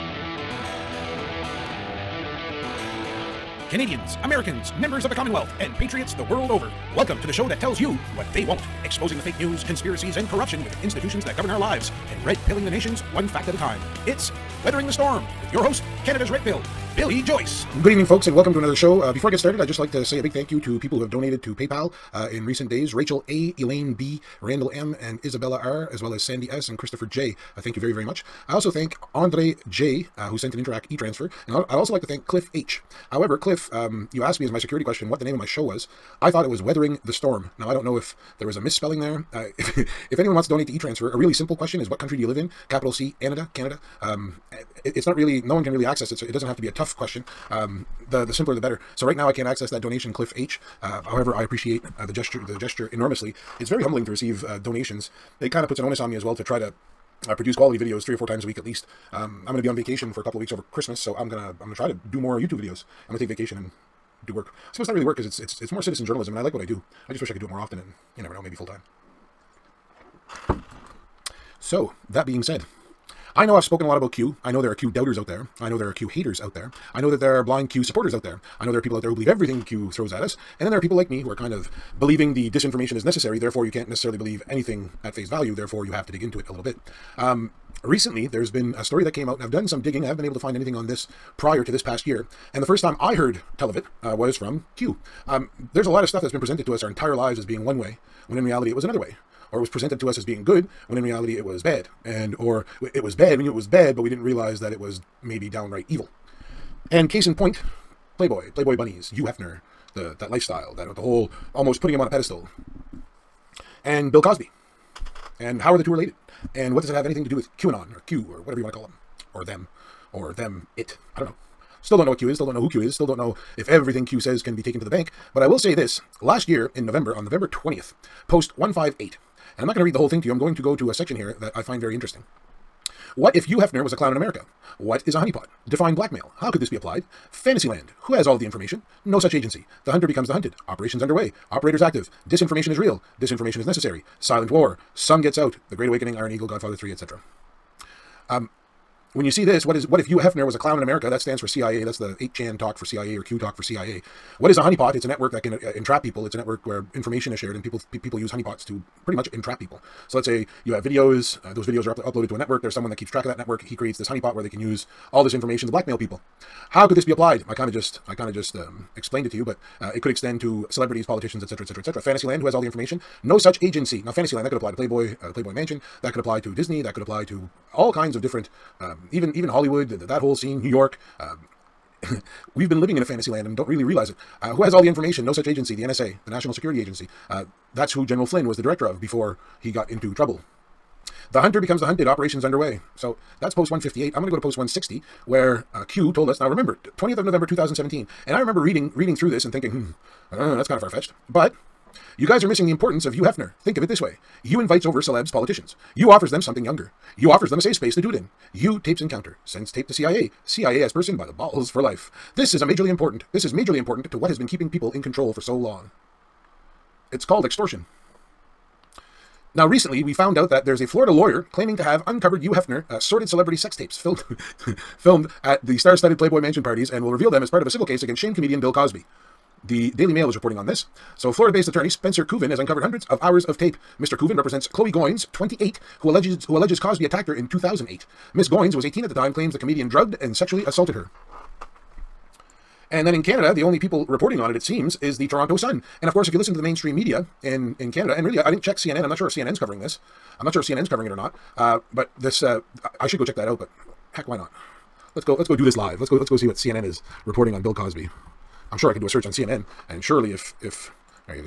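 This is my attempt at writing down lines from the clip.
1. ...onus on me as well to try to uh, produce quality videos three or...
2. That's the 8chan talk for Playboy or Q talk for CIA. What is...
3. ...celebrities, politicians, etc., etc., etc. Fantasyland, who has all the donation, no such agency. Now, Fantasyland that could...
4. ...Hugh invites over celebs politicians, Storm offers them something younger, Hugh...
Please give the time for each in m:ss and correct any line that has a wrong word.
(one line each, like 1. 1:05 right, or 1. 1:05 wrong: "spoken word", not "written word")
1. 0:55 right
2. 2:31 wrong: "CIA", not "Playboy"
3. 2:50 wrong: "information", not "donation"
4. 3:24 wrong: "Hugh", not "Storm".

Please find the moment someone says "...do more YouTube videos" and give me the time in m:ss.
1:02.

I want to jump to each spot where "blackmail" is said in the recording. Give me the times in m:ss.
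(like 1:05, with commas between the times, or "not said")
2:15, 2:45.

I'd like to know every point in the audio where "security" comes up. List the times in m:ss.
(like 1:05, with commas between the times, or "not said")
0:34, 3:06.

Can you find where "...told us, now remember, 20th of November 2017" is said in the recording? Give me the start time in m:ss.
3:16.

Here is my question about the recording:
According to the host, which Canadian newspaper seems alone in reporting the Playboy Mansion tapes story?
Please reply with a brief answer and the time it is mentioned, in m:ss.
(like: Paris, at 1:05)
Toronto Sun, at 4:05.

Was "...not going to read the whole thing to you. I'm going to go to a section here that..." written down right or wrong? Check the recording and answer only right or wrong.
right.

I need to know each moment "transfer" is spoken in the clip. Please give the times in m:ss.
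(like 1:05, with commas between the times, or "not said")
0:30, 0:40.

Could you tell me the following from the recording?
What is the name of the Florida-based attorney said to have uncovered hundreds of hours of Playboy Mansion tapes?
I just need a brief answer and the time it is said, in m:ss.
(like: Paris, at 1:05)
Spencer Kuvin, at 3:51.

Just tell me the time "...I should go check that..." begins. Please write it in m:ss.
4:12.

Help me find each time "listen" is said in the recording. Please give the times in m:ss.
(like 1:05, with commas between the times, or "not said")
4:06.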